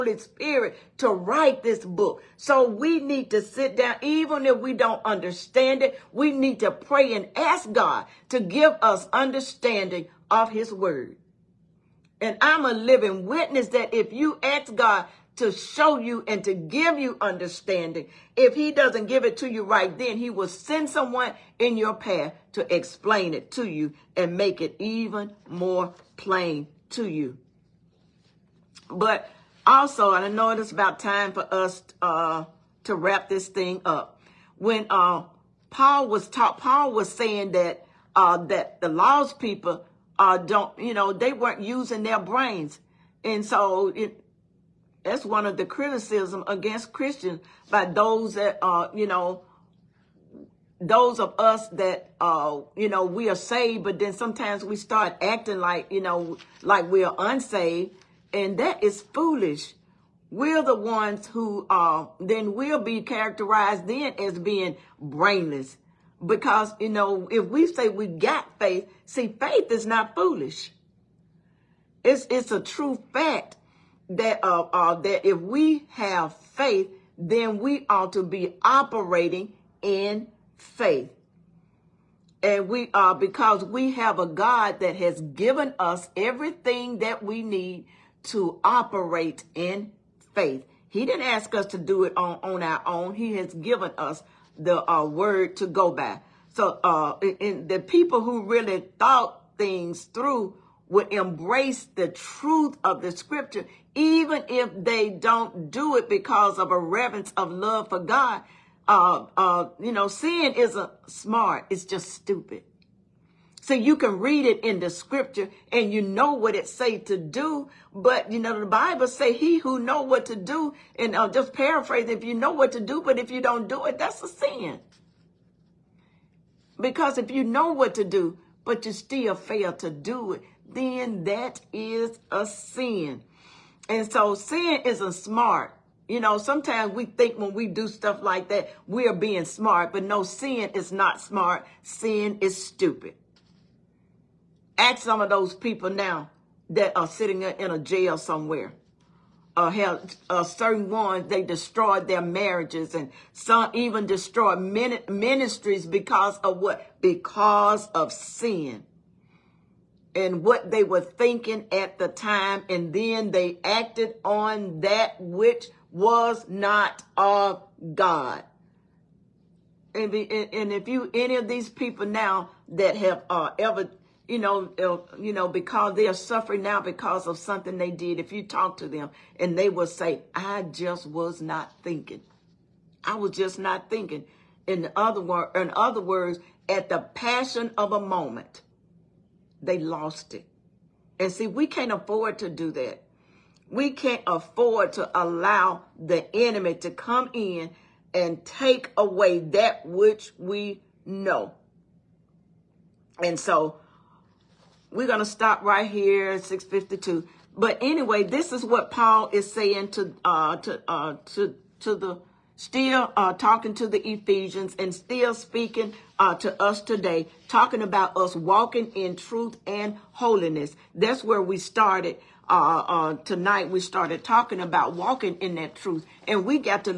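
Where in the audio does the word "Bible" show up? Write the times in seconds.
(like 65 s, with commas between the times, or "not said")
118 s.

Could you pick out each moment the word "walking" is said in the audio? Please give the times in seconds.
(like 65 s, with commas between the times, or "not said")
218 s, 224 s.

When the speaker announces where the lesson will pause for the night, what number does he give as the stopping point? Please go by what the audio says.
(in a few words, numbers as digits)
652.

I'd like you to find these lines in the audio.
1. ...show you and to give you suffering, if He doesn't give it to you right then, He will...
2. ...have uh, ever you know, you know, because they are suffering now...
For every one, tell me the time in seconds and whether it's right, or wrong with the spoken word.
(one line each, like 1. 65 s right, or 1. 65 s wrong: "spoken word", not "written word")
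1. 15 s wrong: "understanding", not "suffering"
2. 172 s right.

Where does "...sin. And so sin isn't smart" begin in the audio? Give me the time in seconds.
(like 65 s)
132 s.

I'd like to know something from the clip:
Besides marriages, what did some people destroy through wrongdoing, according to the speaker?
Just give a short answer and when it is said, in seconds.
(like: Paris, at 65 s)
Ministries, at 155 s.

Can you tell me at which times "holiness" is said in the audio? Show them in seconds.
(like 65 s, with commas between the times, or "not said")
220 s.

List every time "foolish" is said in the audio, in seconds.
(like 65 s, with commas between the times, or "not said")
59 s, 70 s.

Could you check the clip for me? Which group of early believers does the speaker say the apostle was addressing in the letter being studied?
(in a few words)
Ephesians.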